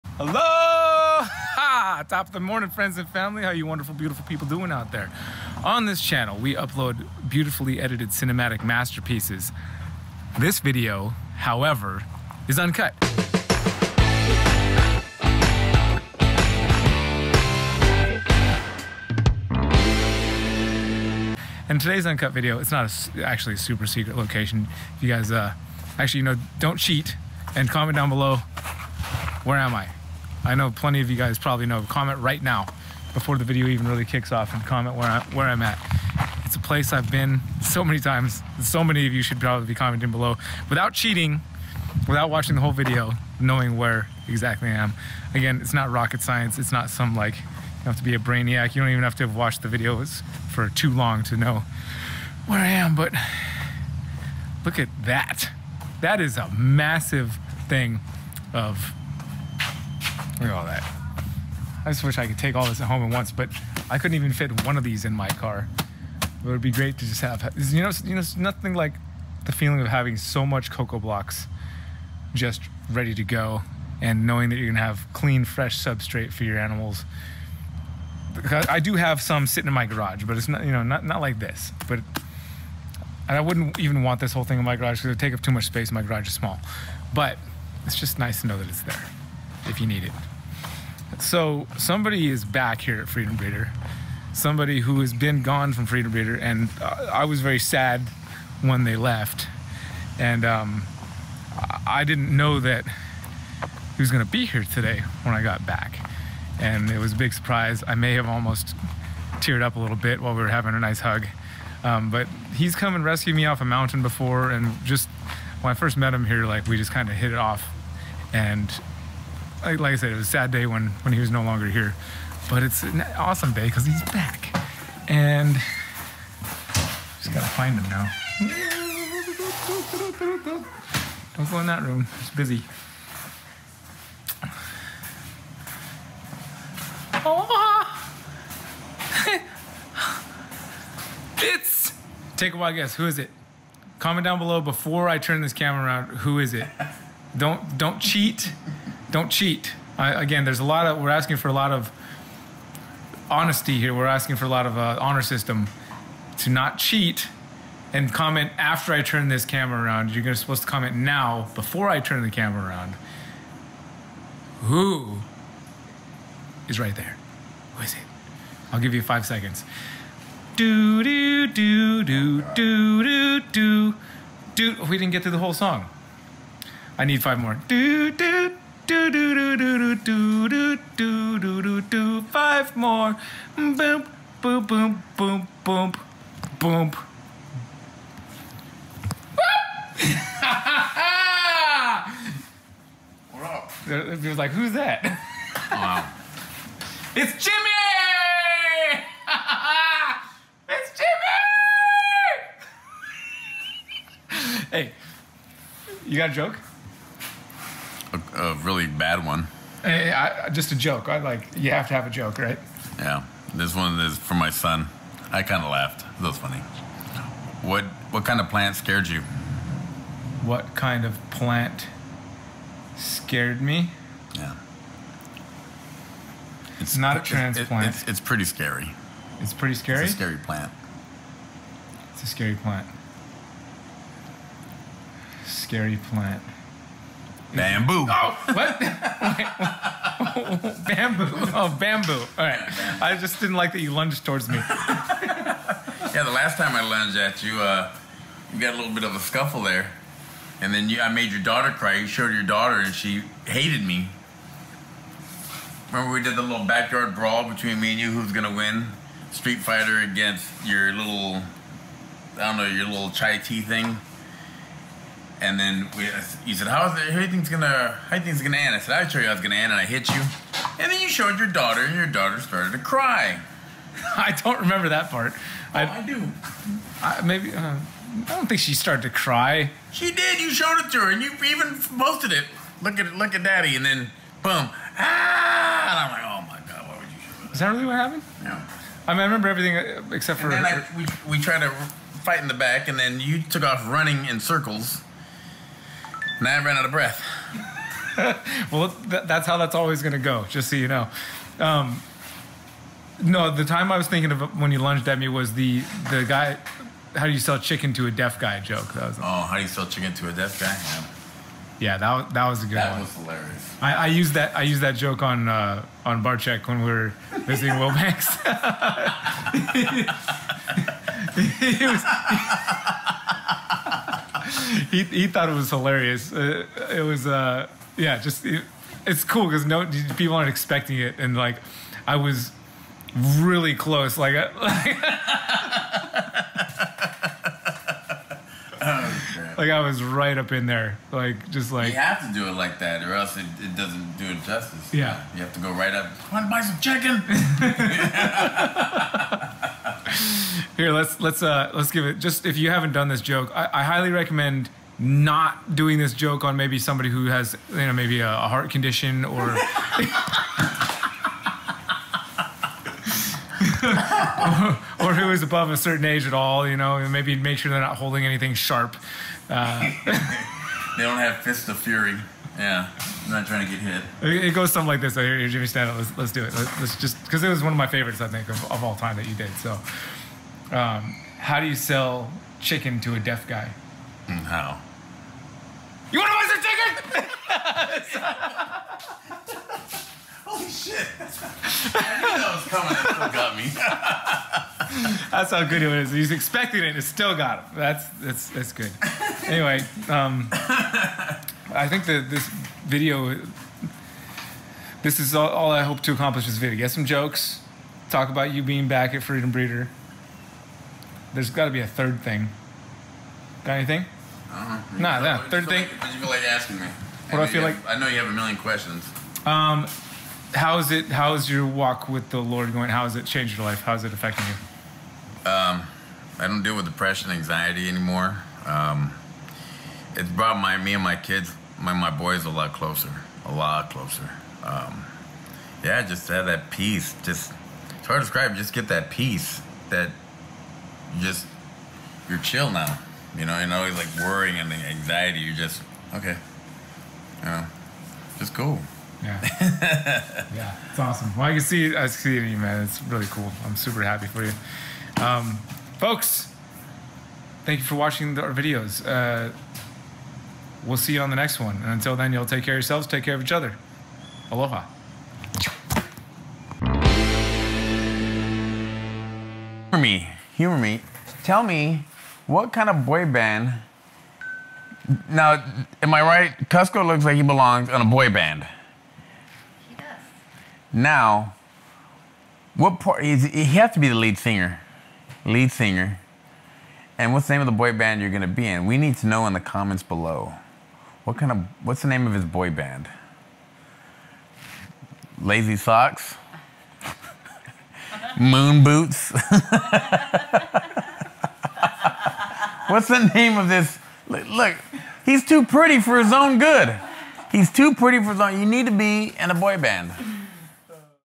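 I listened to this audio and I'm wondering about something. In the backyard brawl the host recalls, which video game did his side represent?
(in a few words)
Street Fighter.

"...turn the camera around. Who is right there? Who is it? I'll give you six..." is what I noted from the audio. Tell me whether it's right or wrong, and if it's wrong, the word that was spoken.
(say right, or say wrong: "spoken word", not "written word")
wrong: "five", not "six".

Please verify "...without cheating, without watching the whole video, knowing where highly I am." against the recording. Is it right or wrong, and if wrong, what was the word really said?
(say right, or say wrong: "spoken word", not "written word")
wrong: "exactly", not "highly".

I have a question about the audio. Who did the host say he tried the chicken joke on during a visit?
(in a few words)
Barchek.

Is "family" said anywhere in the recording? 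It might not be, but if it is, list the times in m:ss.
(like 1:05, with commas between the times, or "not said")
0:03.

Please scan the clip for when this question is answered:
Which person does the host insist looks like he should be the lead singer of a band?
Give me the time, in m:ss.
7:56.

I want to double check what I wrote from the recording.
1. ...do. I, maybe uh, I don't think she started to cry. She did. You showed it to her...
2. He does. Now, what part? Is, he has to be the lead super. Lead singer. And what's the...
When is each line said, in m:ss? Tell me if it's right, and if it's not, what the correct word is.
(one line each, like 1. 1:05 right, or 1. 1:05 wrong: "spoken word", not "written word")
1. 4:36 right
2. 7:59 wrong: "singer", not "super".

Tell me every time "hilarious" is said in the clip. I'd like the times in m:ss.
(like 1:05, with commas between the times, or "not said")
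5:13, 5:25.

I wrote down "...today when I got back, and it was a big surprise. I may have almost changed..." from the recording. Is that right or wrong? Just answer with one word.
wrong.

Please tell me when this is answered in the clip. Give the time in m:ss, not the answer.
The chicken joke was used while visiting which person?
5:17.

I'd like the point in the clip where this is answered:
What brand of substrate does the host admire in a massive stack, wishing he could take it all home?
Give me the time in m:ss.
1:10.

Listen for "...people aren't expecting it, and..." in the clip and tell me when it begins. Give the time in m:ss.
5:30.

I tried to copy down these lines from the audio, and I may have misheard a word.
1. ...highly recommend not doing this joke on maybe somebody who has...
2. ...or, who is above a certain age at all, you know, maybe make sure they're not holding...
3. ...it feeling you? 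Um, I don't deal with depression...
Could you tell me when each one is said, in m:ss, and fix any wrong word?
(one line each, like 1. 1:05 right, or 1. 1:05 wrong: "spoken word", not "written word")
1. 5:53 right
2. 6:05 right
3. 7:04 wrong: "affecting", not "feeling".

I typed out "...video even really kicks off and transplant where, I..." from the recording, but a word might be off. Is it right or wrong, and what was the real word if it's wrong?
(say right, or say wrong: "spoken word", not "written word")
wrong: "comment", not "transplant".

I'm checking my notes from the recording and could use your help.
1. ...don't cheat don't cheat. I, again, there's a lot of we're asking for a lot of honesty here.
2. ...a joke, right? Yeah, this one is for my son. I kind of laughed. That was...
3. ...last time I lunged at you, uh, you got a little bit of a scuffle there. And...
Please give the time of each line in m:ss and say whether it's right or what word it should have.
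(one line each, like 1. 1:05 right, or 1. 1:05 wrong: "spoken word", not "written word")
1. 2:27 right
2. 3:32 right
3. 4:06 right.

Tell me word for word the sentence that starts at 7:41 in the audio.
And until then, y'all take care of yourselves.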